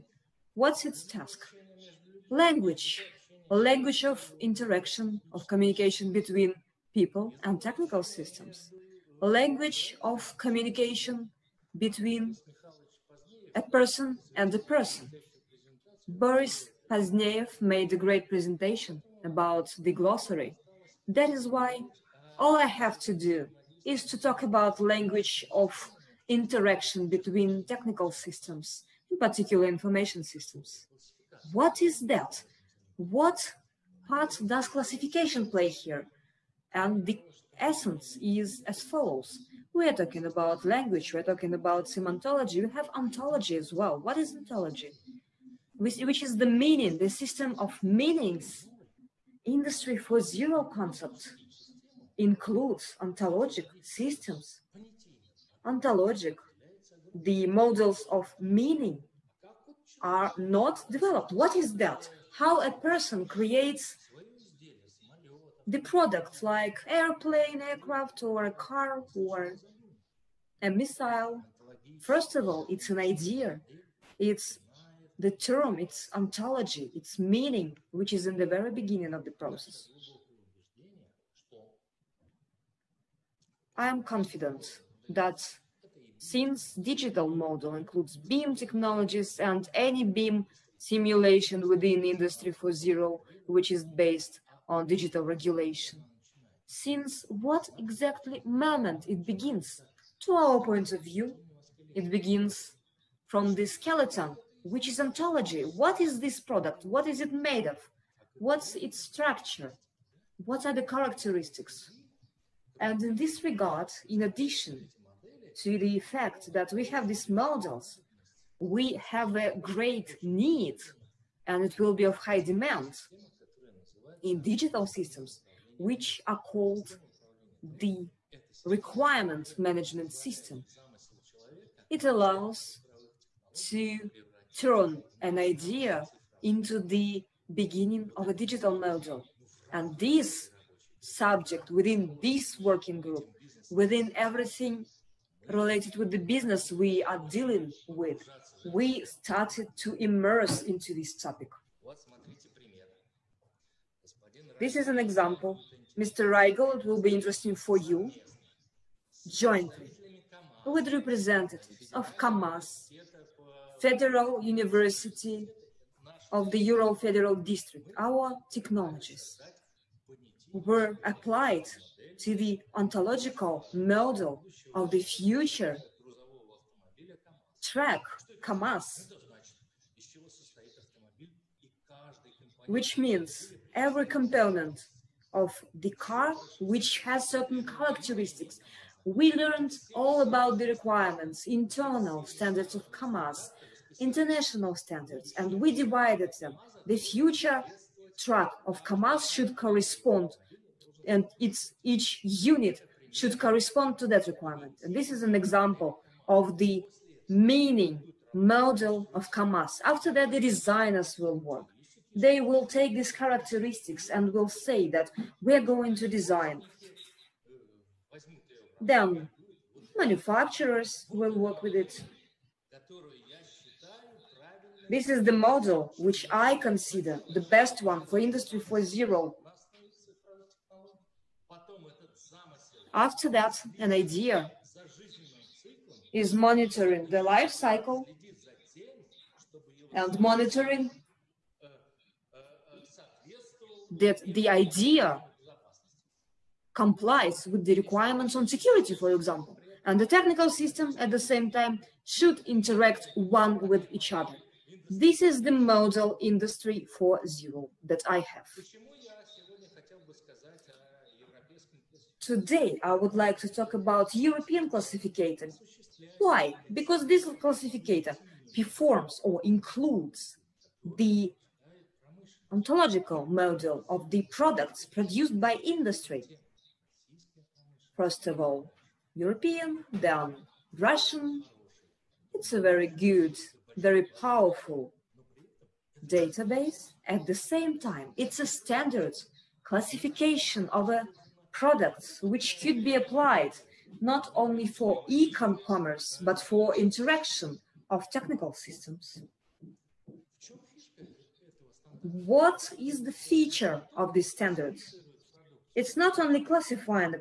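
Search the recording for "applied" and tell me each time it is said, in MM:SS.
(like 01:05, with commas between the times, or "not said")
02:51, 04:52.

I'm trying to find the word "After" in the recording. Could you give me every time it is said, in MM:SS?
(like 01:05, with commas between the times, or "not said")
03:29, 03:52.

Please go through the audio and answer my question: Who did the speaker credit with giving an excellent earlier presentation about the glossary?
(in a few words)
Boris Pozdneev.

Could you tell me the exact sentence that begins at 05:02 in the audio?
What is the feature of these standards?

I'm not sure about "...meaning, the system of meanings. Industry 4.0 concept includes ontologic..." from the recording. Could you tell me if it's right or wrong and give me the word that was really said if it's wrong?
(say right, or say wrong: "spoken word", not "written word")
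right.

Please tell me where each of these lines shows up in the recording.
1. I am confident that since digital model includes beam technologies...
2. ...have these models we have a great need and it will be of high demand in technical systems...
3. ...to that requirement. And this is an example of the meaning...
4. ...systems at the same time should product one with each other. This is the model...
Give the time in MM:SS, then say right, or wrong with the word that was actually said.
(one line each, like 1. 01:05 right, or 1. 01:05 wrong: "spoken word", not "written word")
1. 01:23 right
2. 01:56 wrong: "digital", not "technical"
3. 03:23 right
4. 04:10 wrong: "interact", not "product".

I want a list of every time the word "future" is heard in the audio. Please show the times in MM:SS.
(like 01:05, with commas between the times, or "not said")
02:55, 03:16.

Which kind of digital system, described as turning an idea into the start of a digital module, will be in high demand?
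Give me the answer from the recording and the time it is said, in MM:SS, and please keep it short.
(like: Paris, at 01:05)
requirement management system, at 02:08.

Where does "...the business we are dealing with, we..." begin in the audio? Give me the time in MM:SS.
02:26.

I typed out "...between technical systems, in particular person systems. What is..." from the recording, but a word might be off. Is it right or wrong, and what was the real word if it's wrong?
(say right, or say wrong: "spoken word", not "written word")
wrong: "information", not "person".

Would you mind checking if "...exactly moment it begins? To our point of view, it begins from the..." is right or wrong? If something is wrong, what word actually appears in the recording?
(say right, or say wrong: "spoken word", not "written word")
right.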